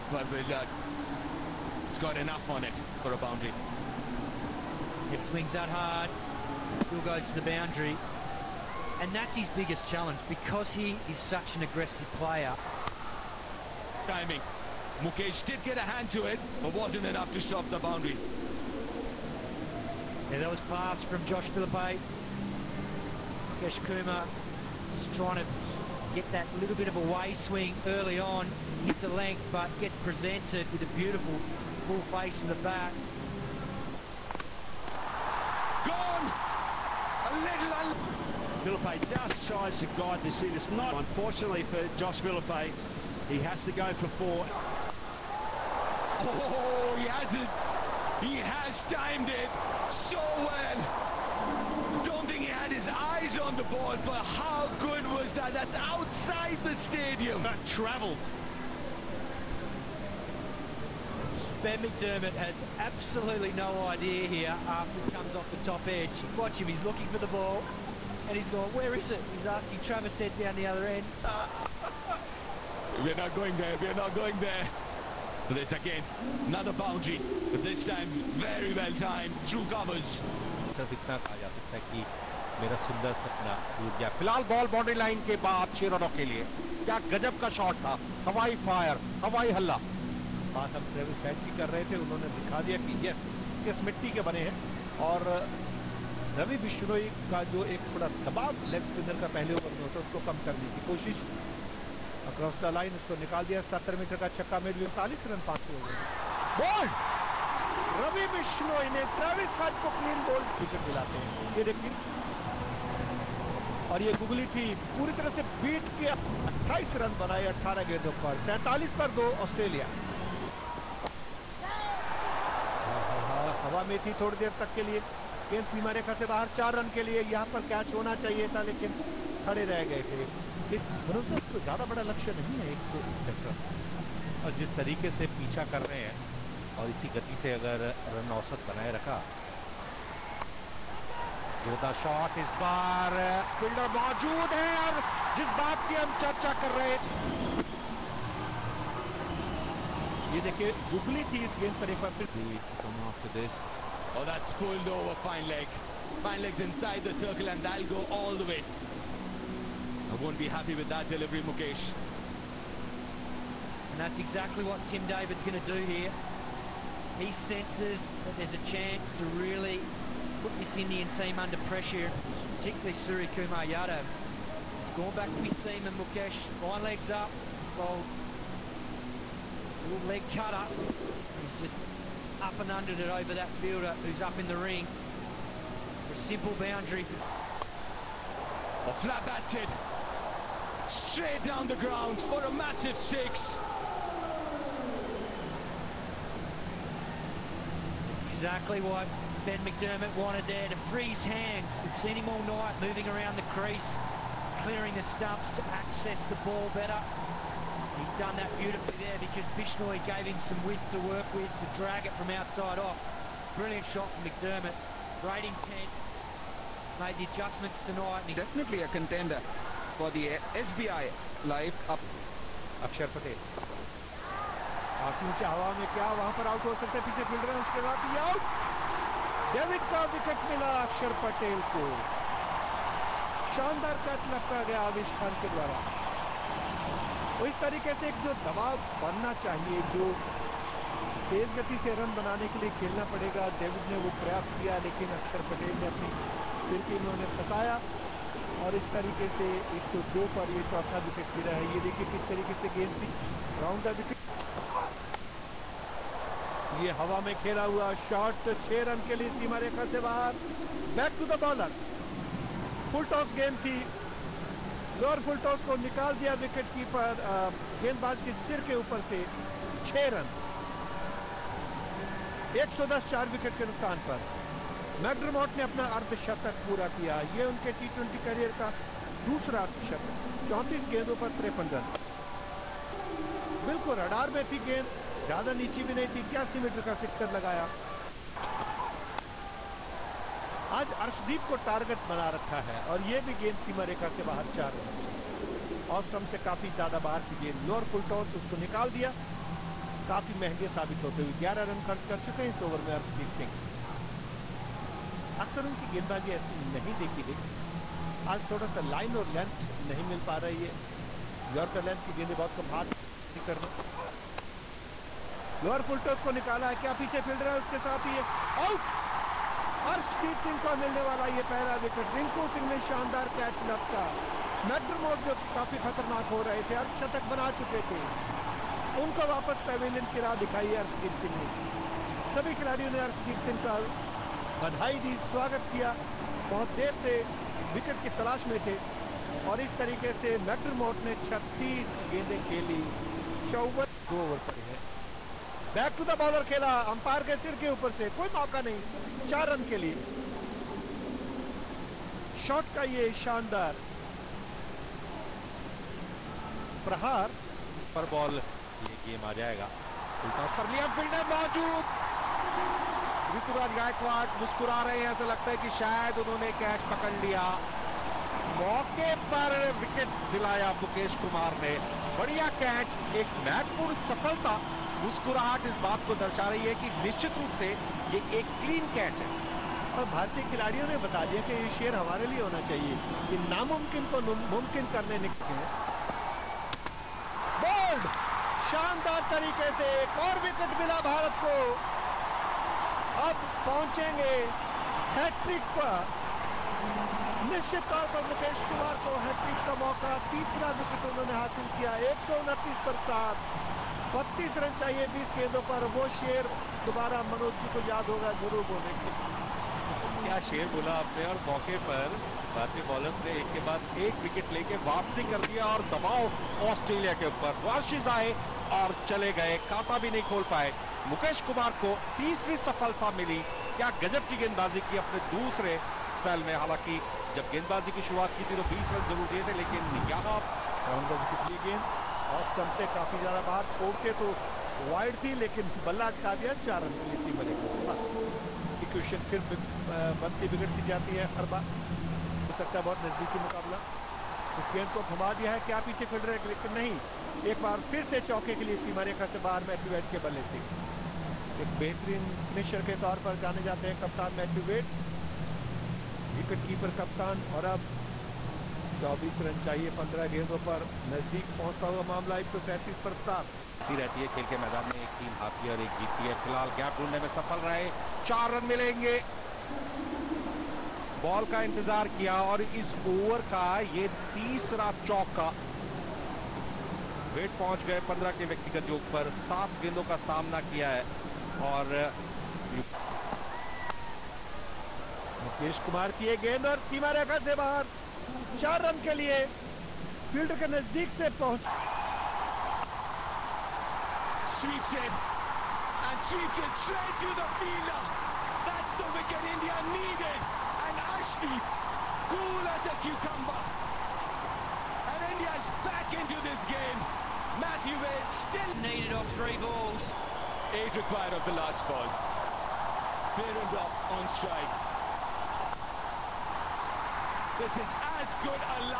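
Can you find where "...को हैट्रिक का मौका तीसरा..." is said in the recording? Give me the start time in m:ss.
6:39.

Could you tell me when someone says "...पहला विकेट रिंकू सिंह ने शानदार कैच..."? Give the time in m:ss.
5:21.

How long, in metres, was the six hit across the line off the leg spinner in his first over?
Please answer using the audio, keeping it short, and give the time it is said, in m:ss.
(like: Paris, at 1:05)
77, at 1:43.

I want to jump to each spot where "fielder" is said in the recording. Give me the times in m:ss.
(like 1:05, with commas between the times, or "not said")
3:03, 8:17.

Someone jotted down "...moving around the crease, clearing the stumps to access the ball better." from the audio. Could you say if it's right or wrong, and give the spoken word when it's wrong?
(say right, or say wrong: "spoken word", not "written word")
right.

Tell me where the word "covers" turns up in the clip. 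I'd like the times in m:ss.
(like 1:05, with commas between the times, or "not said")
1:19.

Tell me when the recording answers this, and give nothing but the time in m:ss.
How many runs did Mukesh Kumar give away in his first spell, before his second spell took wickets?
7:08.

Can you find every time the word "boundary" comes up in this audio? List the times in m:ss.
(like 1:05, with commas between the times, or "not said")
0:03, 0:07, 0:17, 1:16, 3:06.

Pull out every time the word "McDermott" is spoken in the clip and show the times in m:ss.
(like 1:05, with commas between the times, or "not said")
1:01, 3:19, 3:34.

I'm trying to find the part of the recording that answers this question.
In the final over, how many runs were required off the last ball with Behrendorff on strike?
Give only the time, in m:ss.
8:30.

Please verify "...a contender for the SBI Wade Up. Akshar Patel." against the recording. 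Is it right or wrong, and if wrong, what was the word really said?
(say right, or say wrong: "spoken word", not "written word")
wrong: "Live", not "Wade".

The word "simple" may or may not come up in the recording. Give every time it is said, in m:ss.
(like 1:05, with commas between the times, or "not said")
3:06.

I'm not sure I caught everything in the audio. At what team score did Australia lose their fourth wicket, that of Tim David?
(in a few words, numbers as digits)
102.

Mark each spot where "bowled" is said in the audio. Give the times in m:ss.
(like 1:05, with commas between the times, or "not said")
2:57.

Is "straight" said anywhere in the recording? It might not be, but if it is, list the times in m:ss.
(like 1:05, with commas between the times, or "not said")
3:10, 8:16.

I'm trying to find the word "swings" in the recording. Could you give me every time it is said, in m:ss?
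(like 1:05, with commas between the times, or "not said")
0:05, 0:27.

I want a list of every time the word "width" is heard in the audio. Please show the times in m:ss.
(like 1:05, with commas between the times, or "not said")
3:30.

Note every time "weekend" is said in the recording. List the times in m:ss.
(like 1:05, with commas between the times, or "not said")
not said.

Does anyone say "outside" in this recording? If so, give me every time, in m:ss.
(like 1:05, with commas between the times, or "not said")
0:55, 3:32.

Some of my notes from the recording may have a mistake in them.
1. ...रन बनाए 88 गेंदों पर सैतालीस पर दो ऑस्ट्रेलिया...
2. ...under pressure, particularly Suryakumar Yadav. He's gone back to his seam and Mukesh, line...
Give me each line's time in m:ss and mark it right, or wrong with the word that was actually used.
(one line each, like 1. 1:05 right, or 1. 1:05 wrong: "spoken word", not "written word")
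1. 1:57 wrong: "18", not "88"
2. 2:51 right.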